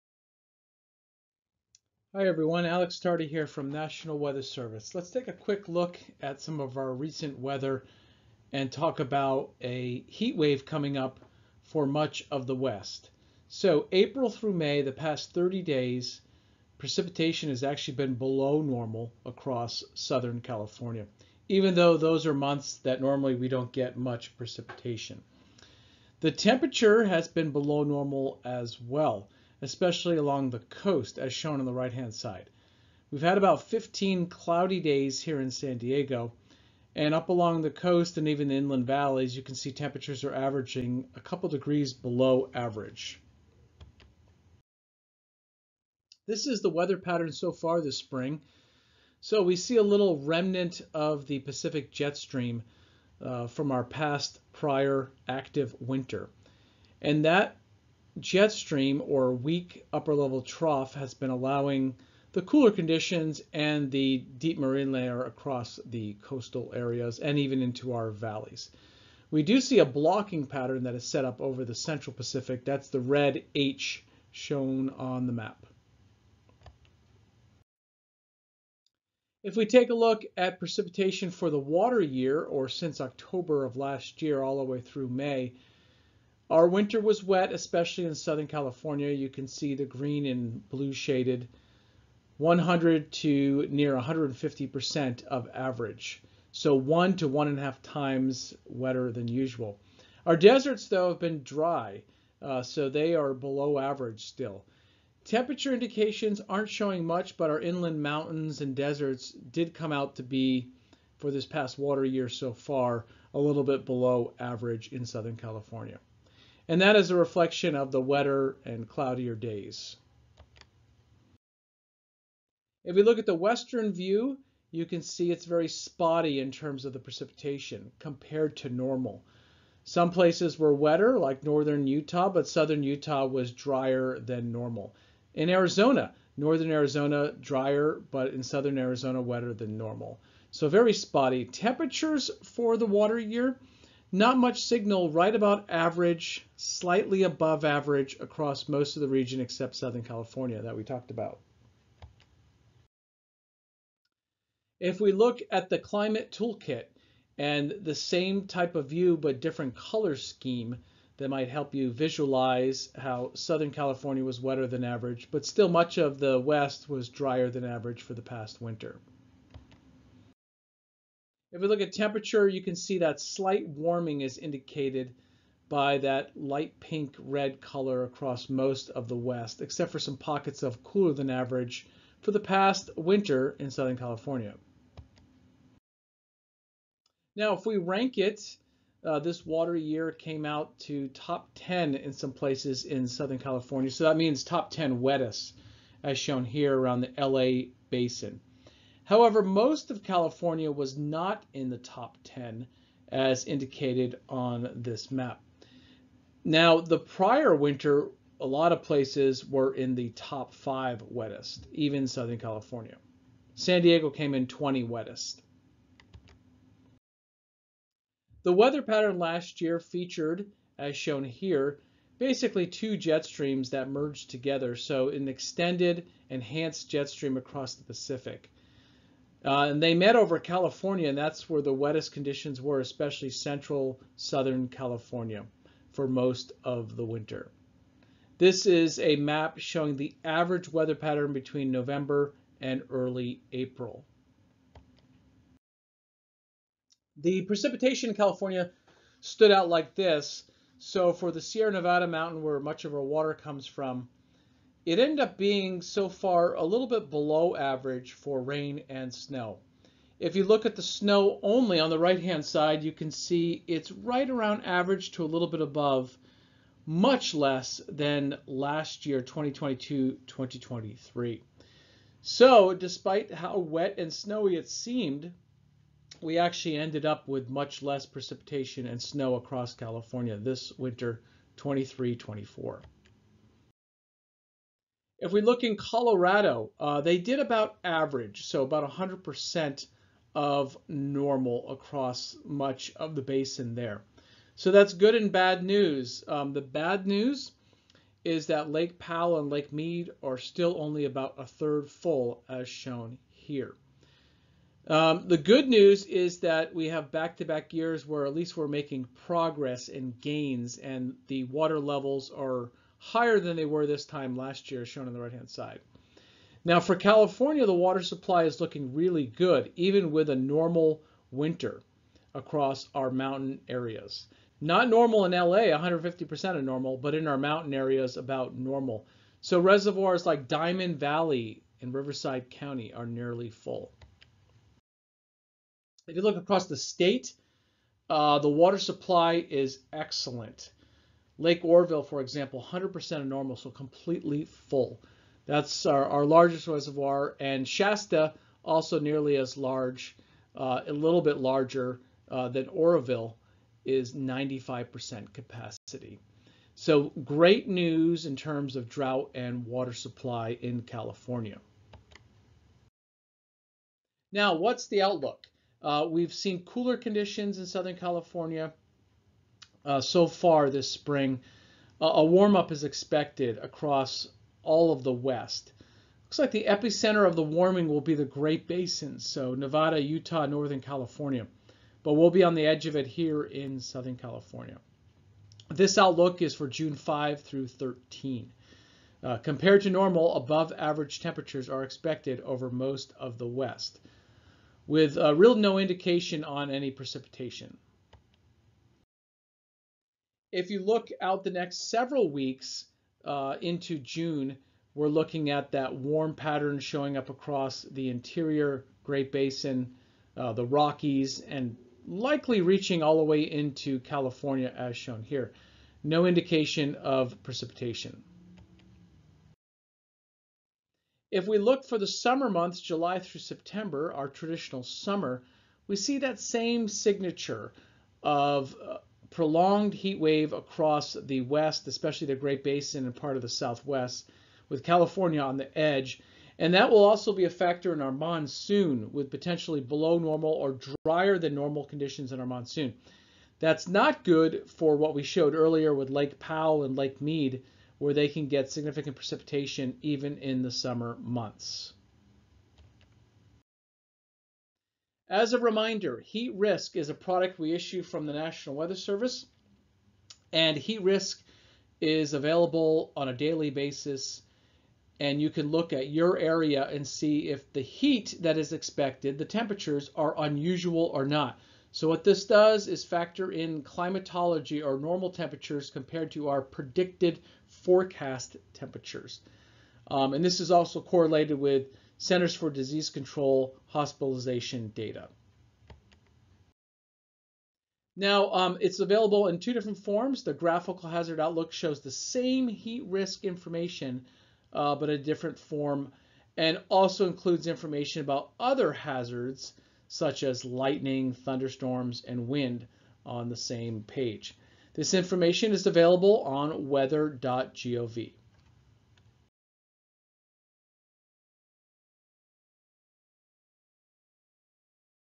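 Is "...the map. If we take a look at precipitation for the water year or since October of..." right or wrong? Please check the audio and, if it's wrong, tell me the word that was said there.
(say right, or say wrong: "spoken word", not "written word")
right.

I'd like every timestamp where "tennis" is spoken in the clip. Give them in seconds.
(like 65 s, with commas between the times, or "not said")
not said.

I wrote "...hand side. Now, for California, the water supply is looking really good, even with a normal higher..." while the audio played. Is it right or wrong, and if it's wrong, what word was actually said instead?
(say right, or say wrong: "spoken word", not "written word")
wrong: "winter", not "higher".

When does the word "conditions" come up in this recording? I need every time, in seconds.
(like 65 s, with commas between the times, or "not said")
62 s, 232 s, 366 s, 441 s.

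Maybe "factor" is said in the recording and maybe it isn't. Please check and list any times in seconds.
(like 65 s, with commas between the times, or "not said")
437 s, 473 s.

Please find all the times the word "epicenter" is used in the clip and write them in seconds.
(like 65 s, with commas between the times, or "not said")
376 s.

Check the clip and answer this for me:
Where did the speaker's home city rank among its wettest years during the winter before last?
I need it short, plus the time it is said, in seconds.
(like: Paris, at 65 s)
20, at 214 s.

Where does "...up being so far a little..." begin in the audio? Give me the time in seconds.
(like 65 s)
255 s.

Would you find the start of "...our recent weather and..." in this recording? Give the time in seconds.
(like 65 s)
6 s.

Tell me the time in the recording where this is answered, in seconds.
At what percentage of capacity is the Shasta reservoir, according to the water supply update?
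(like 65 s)
354 s.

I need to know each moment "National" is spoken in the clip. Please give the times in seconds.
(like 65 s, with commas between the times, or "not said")
3 s, 458 s.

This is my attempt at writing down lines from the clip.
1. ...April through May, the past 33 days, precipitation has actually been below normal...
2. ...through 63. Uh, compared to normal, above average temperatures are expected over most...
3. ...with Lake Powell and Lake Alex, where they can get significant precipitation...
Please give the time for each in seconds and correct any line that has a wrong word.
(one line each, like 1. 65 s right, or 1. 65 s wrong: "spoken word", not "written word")
1. 13 s wrong: "30", not "33"
2. 387 s wrong: "13", not "63"
3. 445 s wrong: "Mead", not "Alex".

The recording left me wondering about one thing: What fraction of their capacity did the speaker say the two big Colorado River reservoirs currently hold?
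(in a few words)
a third.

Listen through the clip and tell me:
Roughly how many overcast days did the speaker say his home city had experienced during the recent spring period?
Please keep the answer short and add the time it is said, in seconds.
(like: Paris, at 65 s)
15, at 33 s.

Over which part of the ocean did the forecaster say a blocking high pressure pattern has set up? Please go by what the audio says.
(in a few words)
central Pacific.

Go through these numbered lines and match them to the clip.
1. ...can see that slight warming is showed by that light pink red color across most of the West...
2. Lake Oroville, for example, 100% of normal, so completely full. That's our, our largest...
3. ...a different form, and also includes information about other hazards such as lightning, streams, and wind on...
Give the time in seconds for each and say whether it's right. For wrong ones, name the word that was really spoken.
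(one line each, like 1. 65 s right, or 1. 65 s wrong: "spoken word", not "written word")
1. 172 s wrong: "indicated", not "showed"
2. 341 s right
3. 495 s wrong: "thunderstorms", not "streams".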